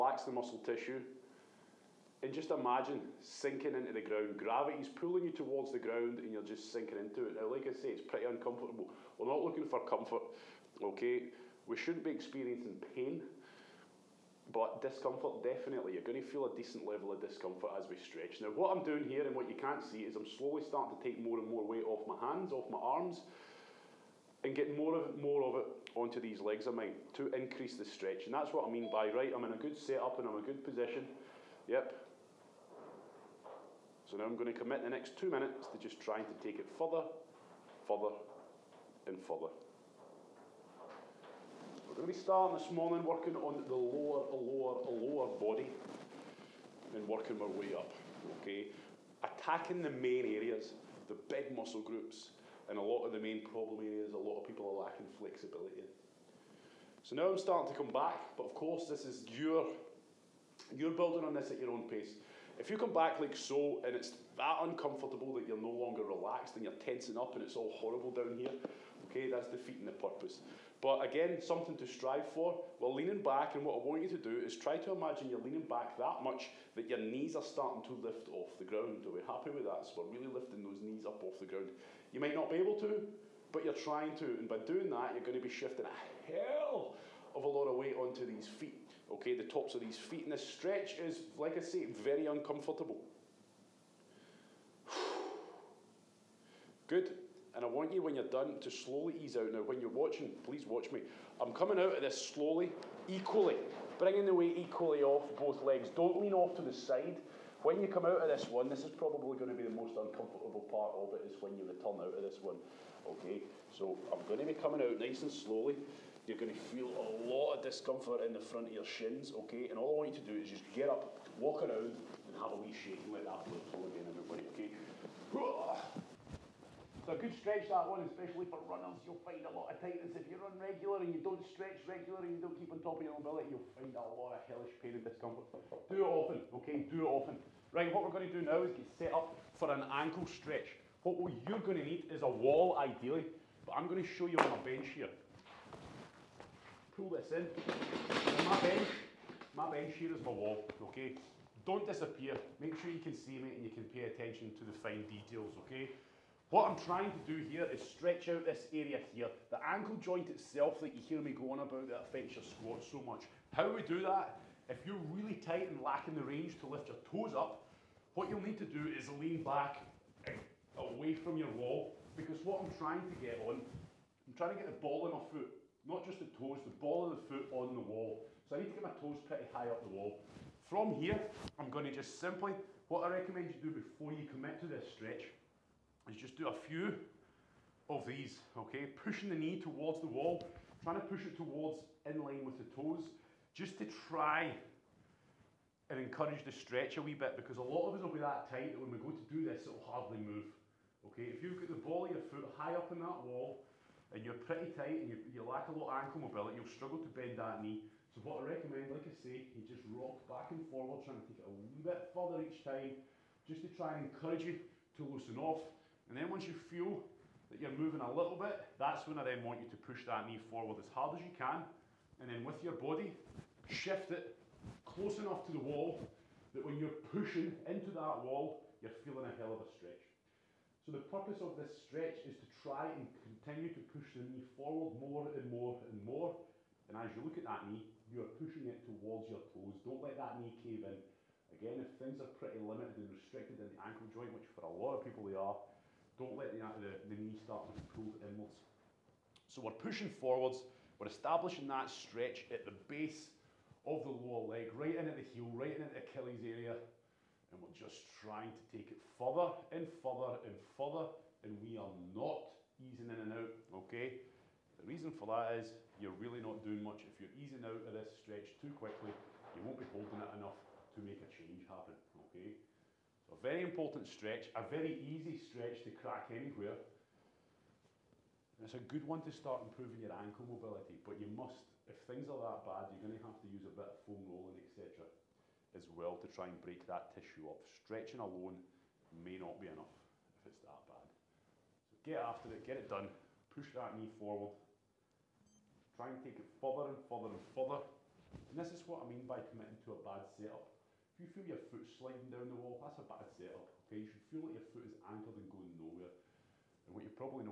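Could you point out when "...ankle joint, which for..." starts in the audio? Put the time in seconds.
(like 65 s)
243 s.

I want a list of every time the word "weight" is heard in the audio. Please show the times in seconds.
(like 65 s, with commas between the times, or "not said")
21 s, 87 s, 104 s.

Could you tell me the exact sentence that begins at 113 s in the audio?
Okay, so I'm going to be coming out nice and slowly.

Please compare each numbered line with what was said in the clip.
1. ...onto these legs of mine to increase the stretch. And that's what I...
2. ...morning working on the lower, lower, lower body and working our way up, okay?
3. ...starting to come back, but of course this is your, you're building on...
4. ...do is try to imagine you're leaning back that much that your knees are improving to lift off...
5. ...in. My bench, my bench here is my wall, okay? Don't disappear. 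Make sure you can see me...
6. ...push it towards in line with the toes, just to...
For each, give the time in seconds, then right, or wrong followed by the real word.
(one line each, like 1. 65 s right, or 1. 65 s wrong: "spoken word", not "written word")
1. 25 s right
2. 42 s right
3. 57 s right
4. 74 s wrong: "starting", not "improving"
5. 147 s right
6. 191 s right.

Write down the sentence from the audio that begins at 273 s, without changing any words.
A very important stretch, a very easy stretch to crack anywhere.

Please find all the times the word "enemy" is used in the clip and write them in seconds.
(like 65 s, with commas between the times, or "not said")
not said.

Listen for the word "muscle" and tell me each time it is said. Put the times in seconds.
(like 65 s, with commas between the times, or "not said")
0 s, 51 s.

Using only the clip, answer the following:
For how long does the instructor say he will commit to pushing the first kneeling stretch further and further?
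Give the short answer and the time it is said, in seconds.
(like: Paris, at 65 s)
2 minutes, at 35 s.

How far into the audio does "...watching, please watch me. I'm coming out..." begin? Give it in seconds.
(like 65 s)
99 s.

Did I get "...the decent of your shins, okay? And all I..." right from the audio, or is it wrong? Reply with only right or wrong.
wrong.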